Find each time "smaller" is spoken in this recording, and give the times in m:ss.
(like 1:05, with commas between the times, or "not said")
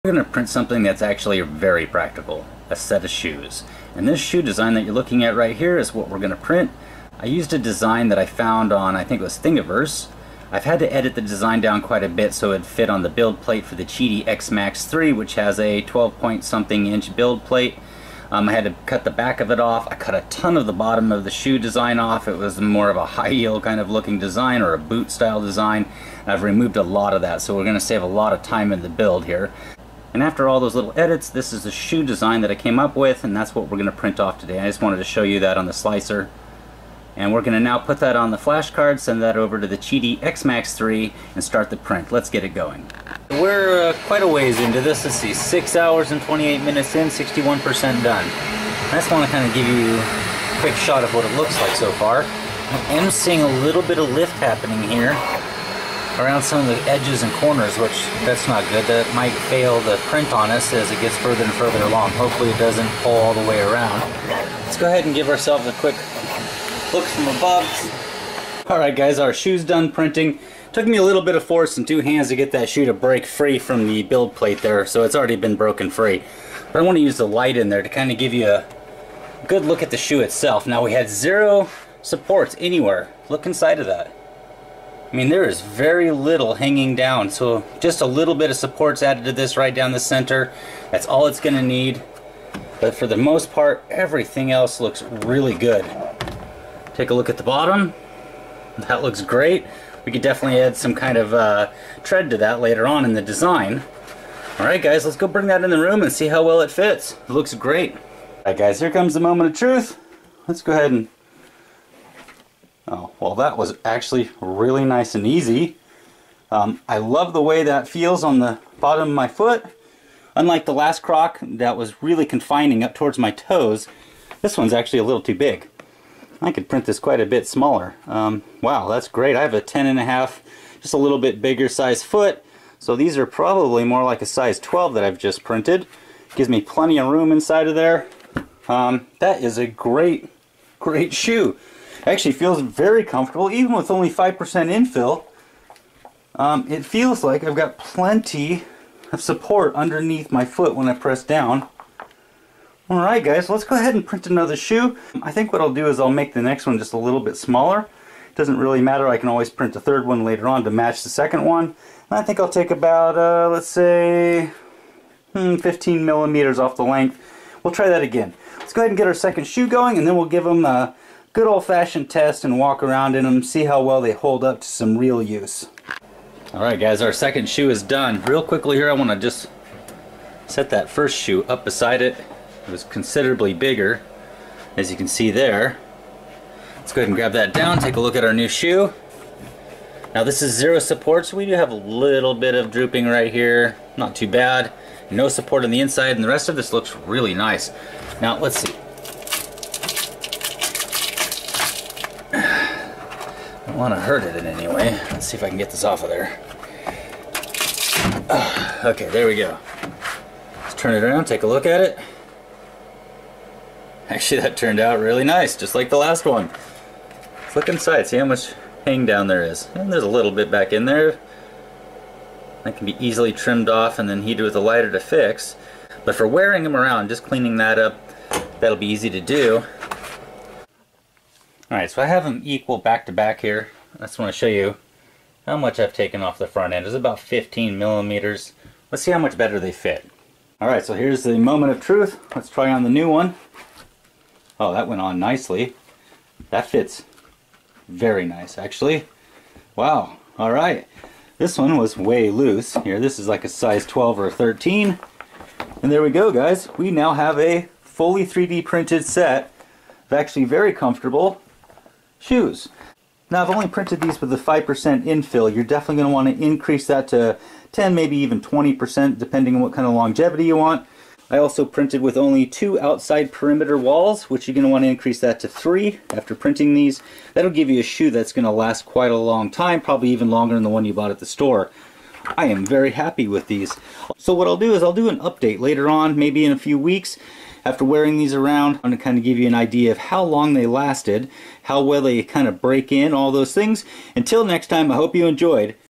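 2:07, 2:37.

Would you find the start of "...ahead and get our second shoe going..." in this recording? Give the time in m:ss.
2:48.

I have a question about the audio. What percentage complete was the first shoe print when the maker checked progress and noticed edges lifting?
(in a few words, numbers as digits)
61%.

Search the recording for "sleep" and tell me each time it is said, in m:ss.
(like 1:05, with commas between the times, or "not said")
not said.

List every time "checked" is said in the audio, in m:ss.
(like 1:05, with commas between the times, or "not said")
not said.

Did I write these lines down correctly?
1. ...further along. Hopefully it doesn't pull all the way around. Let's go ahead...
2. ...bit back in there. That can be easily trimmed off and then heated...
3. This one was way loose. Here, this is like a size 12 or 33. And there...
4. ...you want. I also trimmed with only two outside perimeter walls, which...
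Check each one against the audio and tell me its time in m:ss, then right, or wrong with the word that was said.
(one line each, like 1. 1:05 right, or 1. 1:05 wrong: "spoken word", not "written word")
1. 1:01 right
2. 3:40 right
3. 4:11 wrong: "13", not "33"
4. 4:30 wrong: "printed", not "trimmed".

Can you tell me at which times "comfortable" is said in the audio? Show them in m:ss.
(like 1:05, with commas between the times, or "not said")
2:23, 4:20.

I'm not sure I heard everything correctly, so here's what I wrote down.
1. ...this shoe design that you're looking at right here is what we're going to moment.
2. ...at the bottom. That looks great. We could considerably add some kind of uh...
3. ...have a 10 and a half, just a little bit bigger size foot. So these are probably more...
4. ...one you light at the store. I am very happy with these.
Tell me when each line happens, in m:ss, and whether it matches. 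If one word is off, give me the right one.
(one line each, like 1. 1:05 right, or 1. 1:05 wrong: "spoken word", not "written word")
1. 0:04 wrong: "print", not "moment"
2. 1:37 wrong: "definitely", not "considerably"
3. 2:09 right
4. 4:40 wrong: "bought", not "light".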